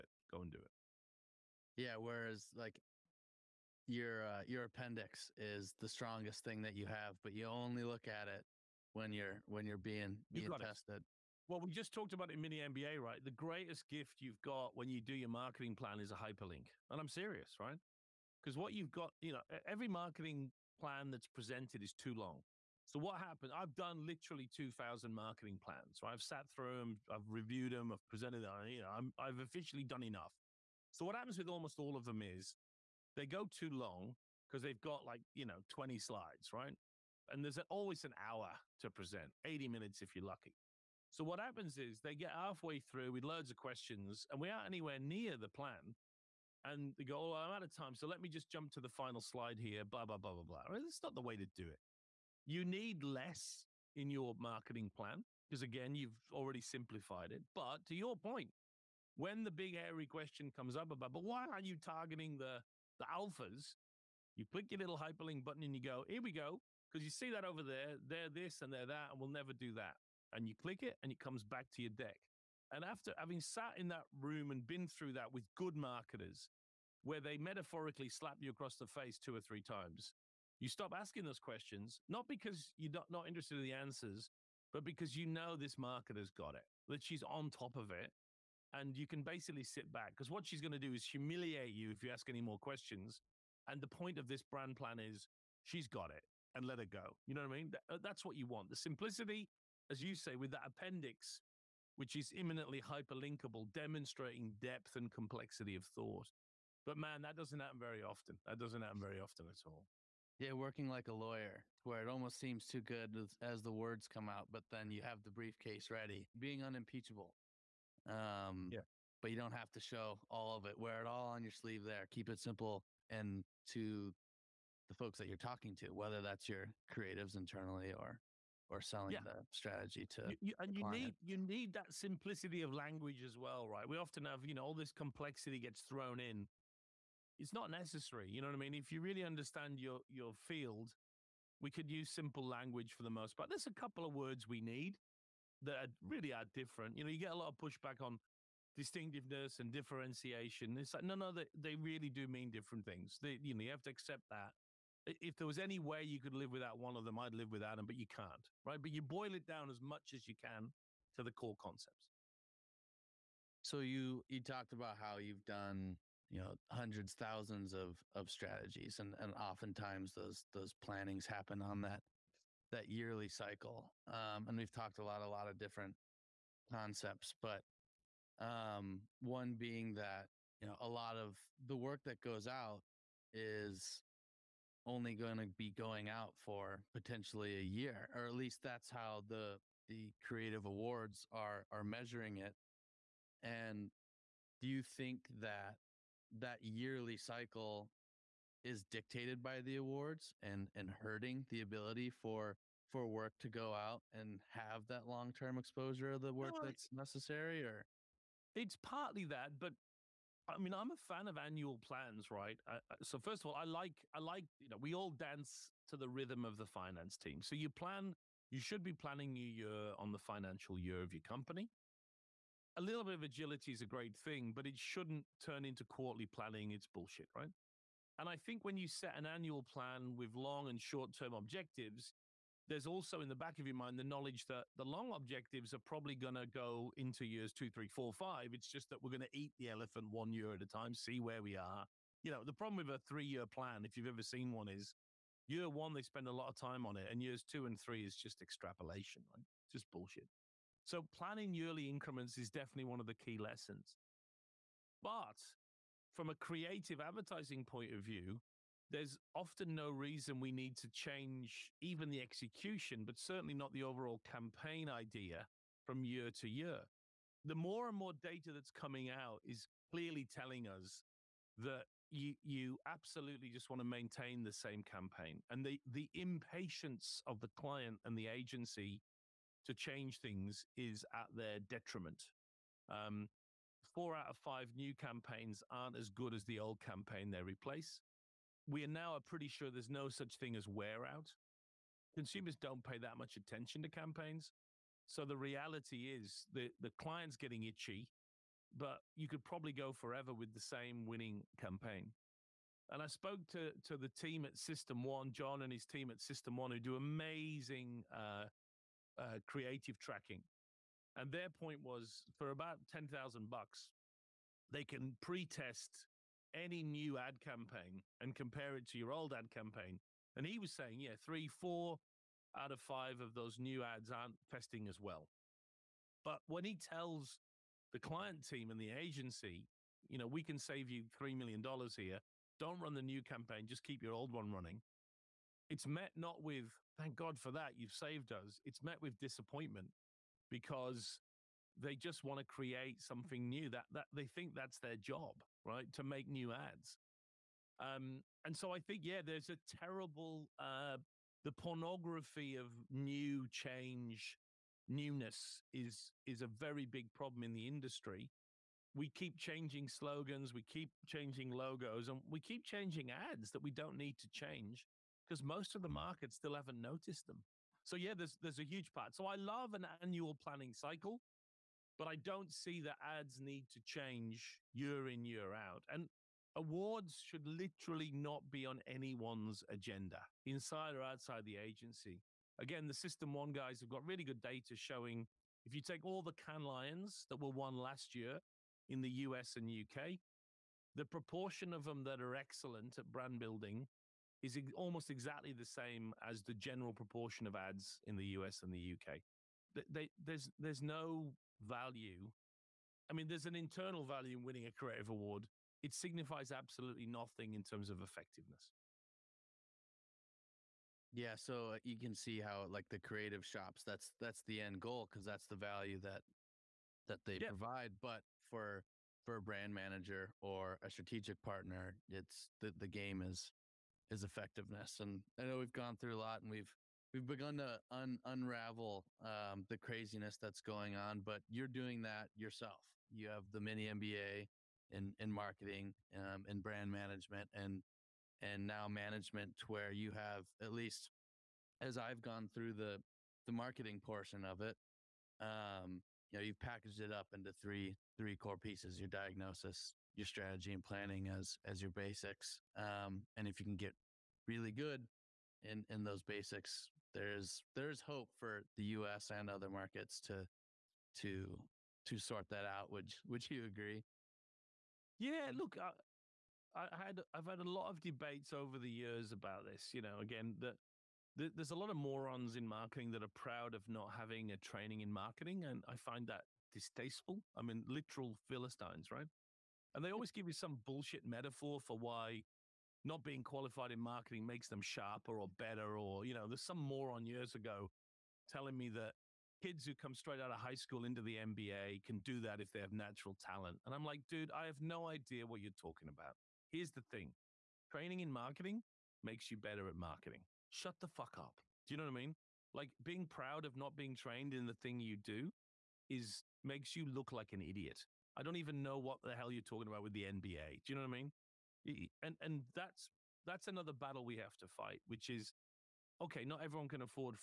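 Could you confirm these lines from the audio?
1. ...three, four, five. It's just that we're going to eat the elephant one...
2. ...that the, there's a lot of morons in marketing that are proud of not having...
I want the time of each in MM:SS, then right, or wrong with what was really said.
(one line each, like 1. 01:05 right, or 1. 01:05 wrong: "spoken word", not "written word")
1. 03:57 right
2. 07:50 right.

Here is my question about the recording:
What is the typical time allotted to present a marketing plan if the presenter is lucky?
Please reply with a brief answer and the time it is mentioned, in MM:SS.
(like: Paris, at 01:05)
80 minutes, at 00:39.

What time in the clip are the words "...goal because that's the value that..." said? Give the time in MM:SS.
06:54.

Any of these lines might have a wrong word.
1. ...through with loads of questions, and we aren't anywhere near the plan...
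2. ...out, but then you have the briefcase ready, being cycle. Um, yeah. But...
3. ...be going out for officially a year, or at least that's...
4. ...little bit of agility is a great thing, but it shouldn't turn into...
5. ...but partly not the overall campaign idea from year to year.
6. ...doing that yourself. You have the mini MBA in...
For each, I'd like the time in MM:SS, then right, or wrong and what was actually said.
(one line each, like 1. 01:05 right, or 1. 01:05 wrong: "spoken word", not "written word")
1. 00:42 right
2. 01:54 wrong: "unimpeachable", not "cycle"
3. 03:05 wrong: "potentially", not "officially"
4. 03:42 right
5. 04:23 wrong: "certainly", not "partly"
6. 07:11 right.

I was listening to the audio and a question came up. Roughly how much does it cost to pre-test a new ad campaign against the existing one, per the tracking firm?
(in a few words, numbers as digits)
$10,000.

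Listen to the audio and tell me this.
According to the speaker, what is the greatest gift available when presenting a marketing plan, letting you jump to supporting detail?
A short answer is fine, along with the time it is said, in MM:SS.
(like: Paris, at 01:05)
A hyperlink, at 00:16.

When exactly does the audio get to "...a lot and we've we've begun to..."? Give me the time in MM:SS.
07:06.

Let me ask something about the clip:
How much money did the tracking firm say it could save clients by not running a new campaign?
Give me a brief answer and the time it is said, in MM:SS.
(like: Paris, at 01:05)
$3 million, at 05:31.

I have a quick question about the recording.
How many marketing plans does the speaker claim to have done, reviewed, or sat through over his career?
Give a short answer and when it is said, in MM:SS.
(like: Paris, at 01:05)
2,000, at 00:24.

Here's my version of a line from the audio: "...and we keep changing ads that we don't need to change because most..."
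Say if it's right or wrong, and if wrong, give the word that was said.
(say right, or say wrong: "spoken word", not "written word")
right.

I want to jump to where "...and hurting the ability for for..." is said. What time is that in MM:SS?
03:20.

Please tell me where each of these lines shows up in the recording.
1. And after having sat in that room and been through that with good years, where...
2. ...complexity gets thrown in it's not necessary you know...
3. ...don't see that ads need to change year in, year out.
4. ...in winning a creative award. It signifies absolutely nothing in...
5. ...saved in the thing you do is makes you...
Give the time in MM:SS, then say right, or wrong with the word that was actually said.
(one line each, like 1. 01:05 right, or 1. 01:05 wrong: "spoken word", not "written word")
1. 01:12 wrong: "marketers", not "years"
2. 02:14 right
3. 06:12 right
4. 06:44 right
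5. 08:24 wrong: "trained", not "saved".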